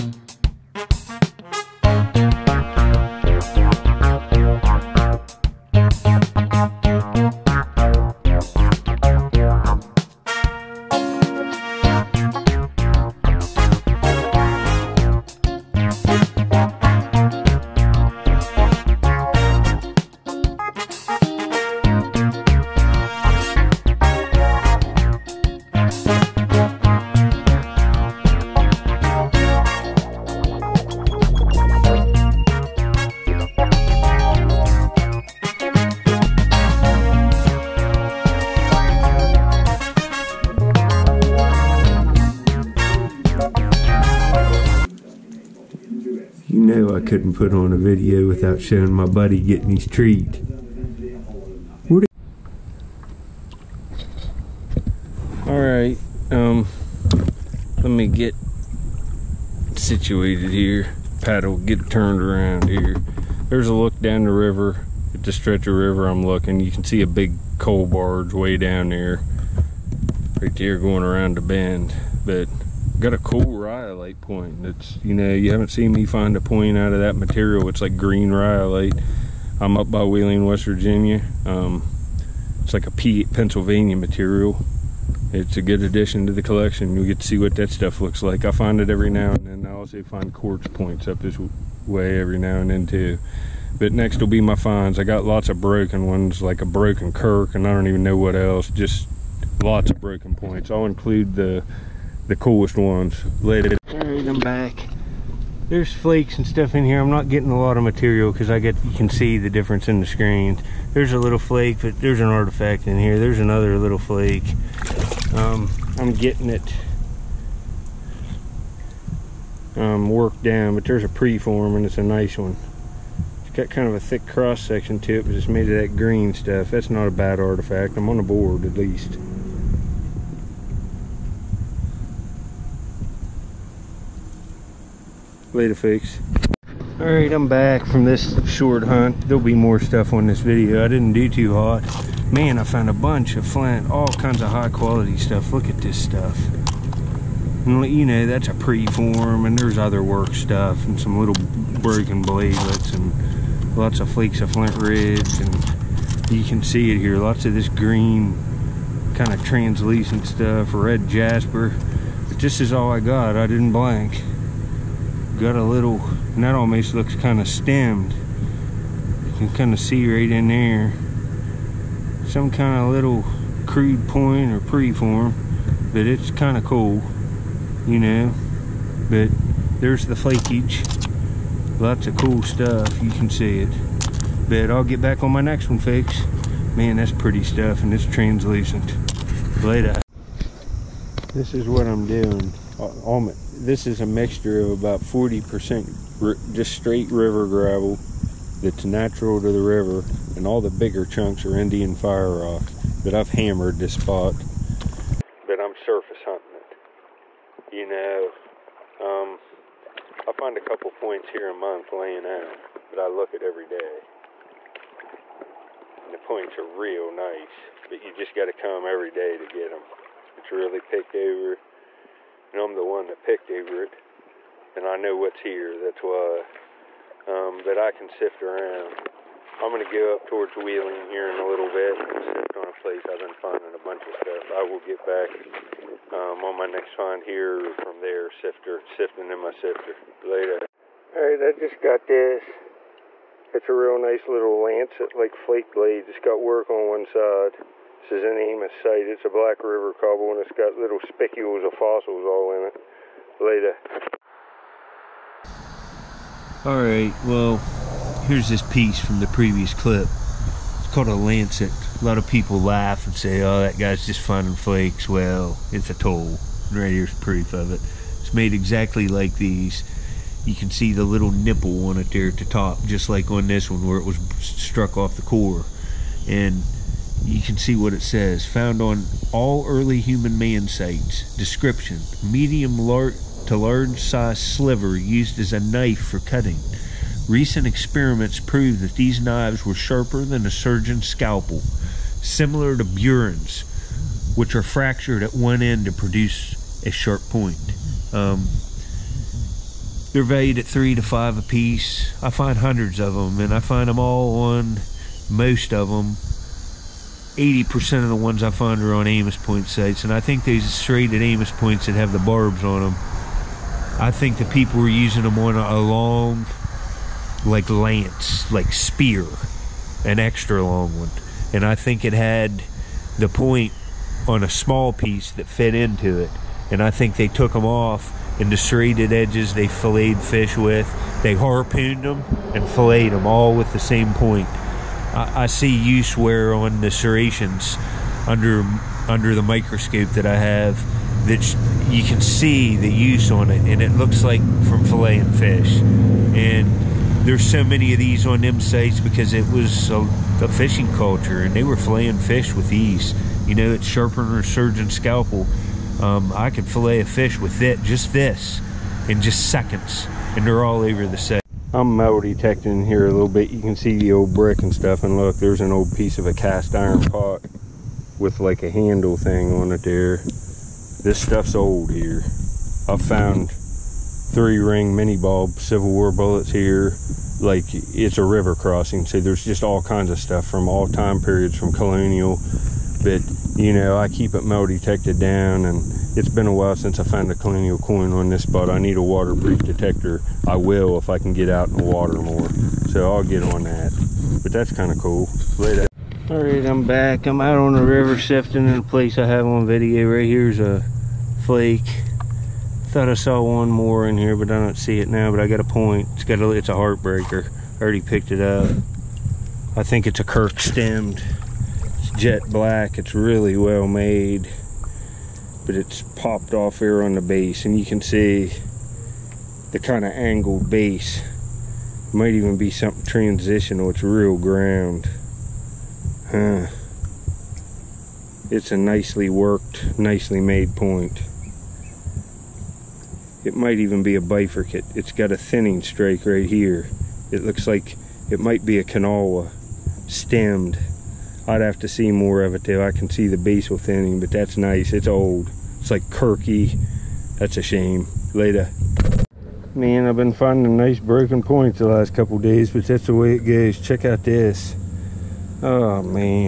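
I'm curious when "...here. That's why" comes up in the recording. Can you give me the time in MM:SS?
03:45.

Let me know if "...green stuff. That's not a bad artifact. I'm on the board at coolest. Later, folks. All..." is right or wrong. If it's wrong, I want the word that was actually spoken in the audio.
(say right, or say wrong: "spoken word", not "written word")
wrong: "least", not "coolest".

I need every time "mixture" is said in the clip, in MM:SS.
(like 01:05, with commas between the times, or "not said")
03:14.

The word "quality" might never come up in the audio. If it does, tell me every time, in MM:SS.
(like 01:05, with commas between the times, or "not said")
02:24.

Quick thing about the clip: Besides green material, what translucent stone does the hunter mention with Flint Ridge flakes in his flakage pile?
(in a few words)
Red jasper.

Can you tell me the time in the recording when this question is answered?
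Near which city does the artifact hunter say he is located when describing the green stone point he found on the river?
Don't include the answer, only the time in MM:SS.
01:20.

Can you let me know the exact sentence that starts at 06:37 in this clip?
I'm out on the river sifting in a place I have on video.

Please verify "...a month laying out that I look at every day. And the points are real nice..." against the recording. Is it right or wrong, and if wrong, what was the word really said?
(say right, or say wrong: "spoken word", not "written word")
right.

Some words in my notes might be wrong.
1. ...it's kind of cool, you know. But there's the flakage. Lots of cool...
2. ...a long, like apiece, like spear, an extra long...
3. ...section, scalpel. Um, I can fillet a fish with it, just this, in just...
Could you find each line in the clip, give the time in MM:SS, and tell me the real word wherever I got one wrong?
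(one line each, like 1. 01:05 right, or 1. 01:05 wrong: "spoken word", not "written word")
1. 02:56 right
2. 05:15 wrong: "lance", not "apiece"
3. 05:54 wrong: "surgeon", not "section".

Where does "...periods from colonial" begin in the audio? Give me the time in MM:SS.
06:21.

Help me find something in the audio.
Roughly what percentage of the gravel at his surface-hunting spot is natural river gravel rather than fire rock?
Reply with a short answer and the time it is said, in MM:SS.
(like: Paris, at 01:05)
40%, at 03:14.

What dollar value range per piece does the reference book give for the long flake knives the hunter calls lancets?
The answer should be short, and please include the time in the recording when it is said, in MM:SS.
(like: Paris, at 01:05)
3 to 5, at 05:00.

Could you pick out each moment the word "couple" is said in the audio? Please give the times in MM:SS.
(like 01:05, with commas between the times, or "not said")
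03:30, 07:32.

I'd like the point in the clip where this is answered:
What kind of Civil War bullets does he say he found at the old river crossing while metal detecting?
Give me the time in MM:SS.
06:13.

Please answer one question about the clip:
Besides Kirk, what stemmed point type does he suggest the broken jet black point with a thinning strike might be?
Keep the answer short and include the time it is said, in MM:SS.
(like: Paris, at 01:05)
Kanawha stemmed, at 07:18.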